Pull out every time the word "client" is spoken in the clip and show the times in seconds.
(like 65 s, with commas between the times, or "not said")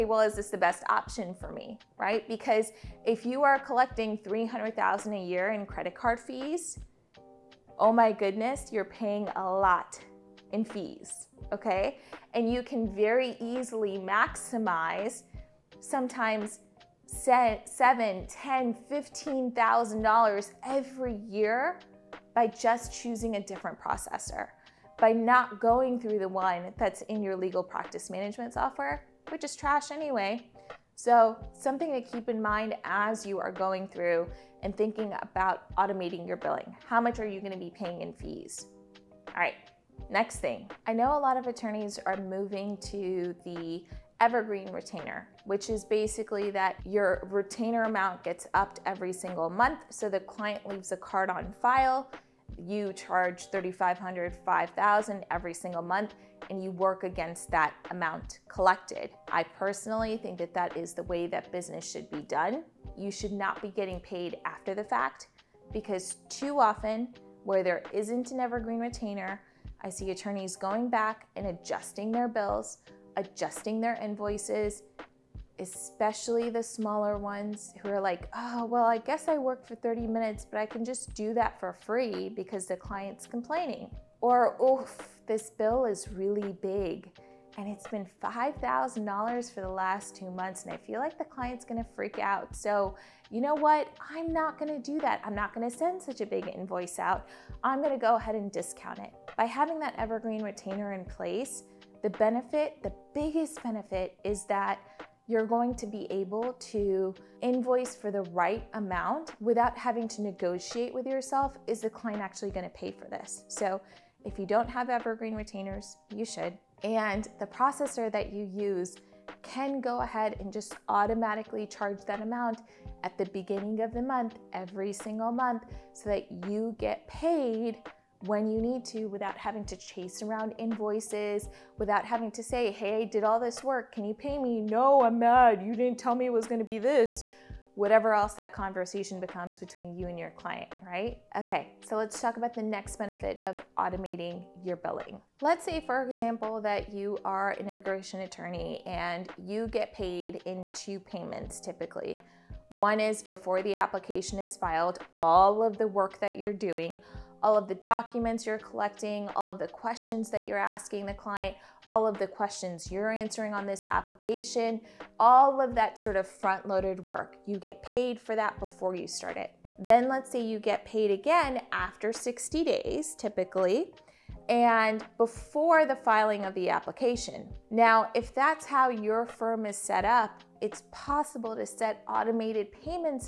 50 s, 82 s, 91 s, 111 s, 140 s, 161 s.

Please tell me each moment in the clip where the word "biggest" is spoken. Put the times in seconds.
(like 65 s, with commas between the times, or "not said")
103 s.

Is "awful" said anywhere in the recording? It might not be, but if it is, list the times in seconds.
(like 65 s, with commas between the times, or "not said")
not said.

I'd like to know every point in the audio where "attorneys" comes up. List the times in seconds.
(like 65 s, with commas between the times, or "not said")
41 s, 70 s, 148 s.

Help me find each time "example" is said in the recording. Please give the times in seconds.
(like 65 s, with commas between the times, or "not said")
146 s.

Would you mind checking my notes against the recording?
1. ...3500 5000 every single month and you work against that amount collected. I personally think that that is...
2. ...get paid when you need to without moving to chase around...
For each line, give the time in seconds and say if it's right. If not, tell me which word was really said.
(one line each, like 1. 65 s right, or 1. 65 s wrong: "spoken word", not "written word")
1. 53 s right
2. 126 s wrong: "having", not "moving".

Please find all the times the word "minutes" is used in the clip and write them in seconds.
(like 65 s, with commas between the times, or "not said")
80 s.